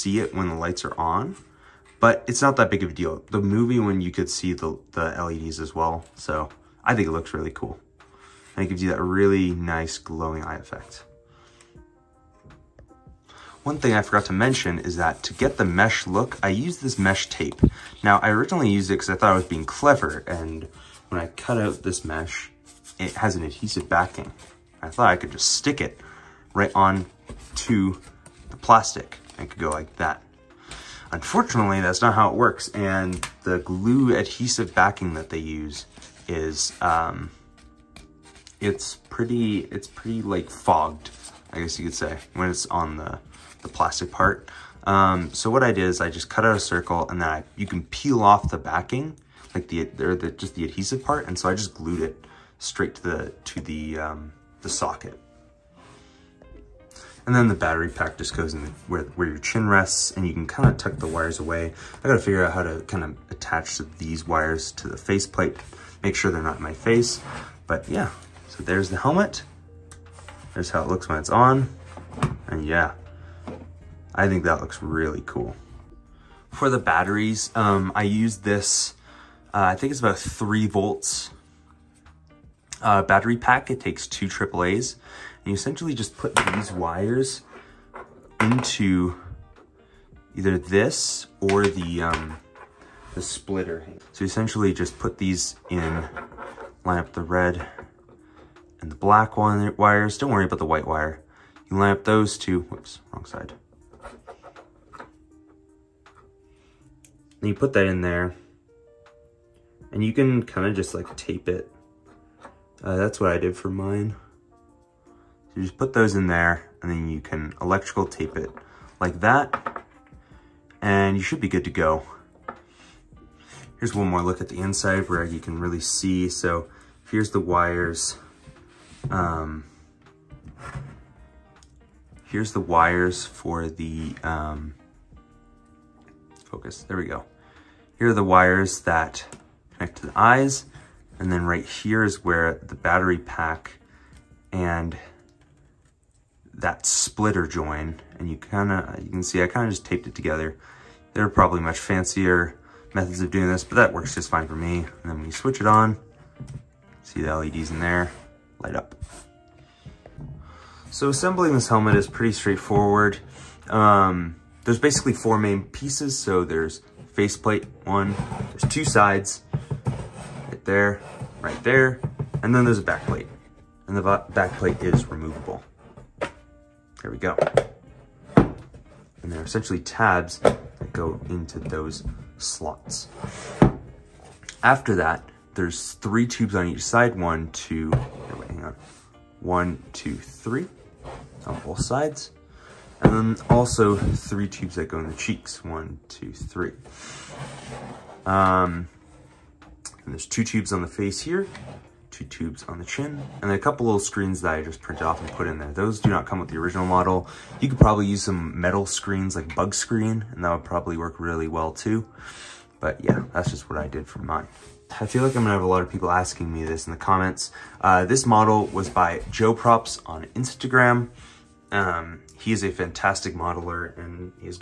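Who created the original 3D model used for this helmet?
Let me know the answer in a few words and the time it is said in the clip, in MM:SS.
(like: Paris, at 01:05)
Joe Props, at 03:39.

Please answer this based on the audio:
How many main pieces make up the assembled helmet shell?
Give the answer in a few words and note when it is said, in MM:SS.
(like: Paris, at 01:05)
4, at 02:45.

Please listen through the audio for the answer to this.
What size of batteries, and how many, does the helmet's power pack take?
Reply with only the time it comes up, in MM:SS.
01:24.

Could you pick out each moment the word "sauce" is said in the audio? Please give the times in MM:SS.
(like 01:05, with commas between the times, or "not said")
not said.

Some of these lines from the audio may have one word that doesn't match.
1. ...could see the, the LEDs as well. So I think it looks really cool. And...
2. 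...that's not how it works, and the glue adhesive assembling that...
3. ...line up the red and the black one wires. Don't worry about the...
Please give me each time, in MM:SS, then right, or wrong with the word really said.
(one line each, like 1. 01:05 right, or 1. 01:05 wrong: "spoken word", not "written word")
1. 00:04 right
2. 00:31 wrong: "backing", not "assembling"
3. 01:36 right.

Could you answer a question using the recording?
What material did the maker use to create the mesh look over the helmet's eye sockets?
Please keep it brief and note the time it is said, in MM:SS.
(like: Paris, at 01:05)
Mesh tape, at 00:16.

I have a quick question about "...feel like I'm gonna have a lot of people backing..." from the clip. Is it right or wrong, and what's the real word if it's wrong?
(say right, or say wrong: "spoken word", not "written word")
wrong: "asking", not "backing".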